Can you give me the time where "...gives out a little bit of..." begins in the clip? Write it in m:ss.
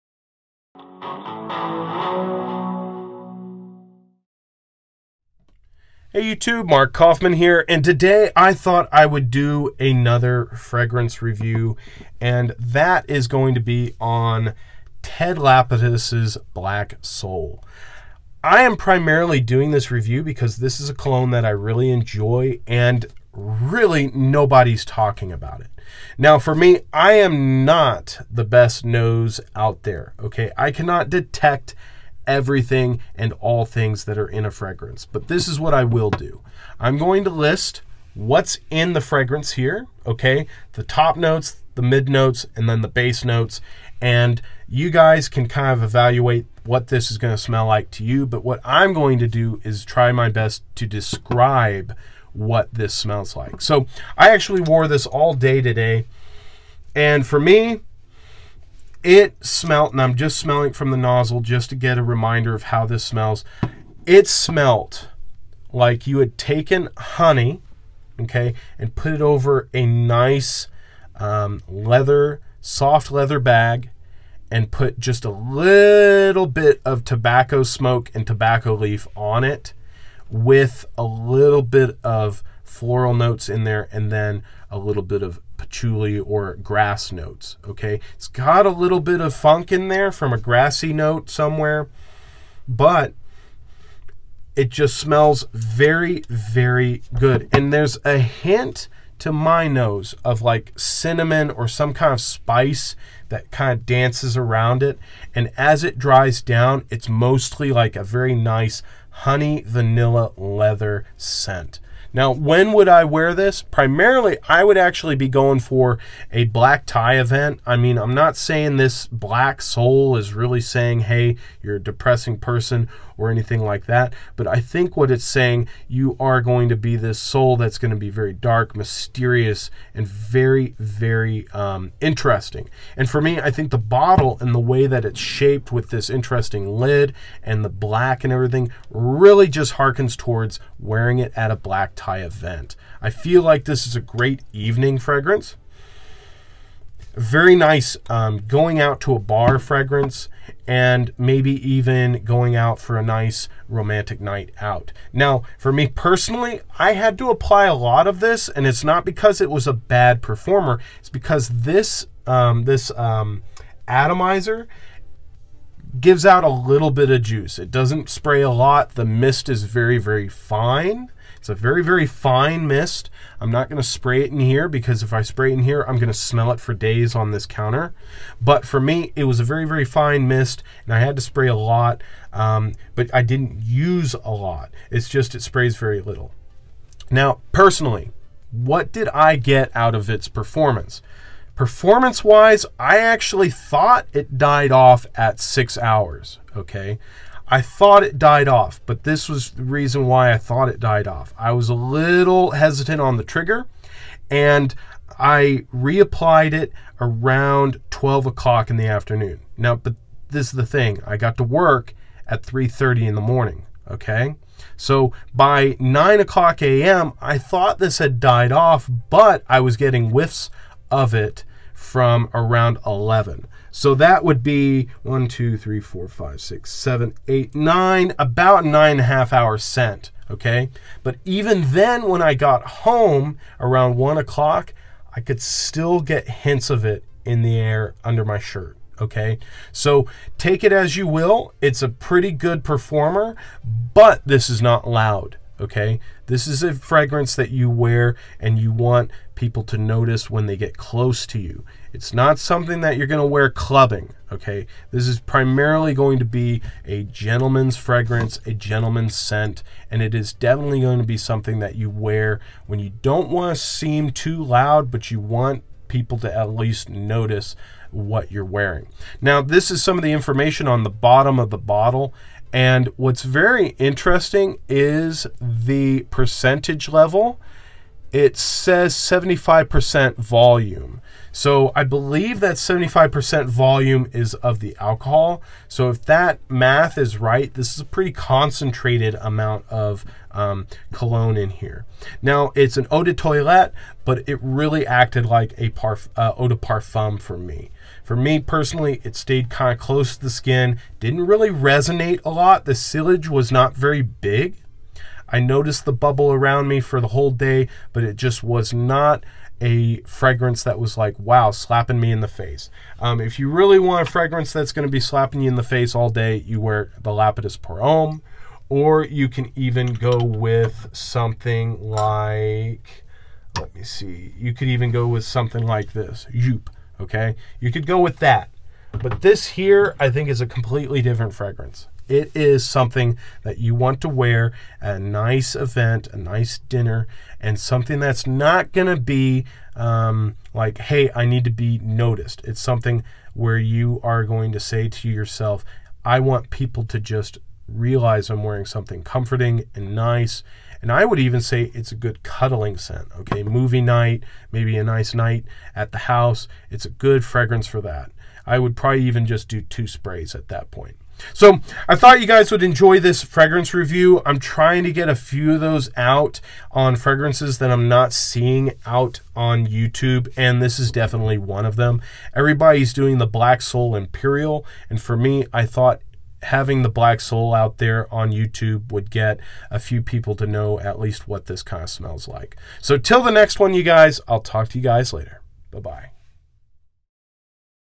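2:45.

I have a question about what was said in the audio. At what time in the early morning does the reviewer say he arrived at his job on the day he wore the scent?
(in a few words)
3:30 a.m.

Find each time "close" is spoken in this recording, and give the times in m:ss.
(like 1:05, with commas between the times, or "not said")
4:10, 4:59.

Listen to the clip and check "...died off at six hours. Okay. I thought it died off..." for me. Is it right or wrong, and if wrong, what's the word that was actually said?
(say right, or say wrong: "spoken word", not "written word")
right.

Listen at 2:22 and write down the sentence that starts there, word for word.
I feel like this is a great evening fragrance.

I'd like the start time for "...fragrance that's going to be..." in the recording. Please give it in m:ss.
5:14.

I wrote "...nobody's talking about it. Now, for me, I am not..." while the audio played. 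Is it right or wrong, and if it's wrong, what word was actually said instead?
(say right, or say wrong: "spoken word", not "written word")
right.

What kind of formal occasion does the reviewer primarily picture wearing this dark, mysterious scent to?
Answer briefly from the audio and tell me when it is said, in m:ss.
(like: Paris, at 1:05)
Black tie event, at 1:56.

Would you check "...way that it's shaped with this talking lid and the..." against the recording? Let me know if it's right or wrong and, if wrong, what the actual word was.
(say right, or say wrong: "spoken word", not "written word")
wrong: "interesting", not "talking".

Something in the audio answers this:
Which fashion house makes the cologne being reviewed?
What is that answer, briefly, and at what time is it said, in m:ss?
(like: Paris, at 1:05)
Ted Lapidus, at 0:15.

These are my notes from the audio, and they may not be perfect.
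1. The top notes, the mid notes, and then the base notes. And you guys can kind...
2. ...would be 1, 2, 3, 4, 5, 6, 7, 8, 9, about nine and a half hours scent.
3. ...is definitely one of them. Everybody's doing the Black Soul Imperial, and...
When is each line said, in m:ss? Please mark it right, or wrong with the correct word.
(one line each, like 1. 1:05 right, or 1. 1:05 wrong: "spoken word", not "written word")
1. 0:40 right
2. 3:44 right
3. 6:10 right.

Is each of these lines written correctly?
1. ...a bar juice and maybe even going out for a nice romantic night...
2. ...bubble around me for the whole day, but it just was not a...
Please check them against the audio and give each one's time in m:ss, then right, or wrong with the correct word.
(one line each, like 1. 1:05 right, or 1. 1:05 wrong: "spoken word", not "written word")
1. 2:29 wrong: "fragrance", not "juice"
2. 5:05 right.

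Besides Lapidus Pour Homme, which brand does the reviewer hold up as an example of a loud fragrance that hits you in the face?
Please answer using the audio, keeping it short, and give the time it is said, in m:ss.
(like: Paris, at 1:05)
Joop, at 5:26.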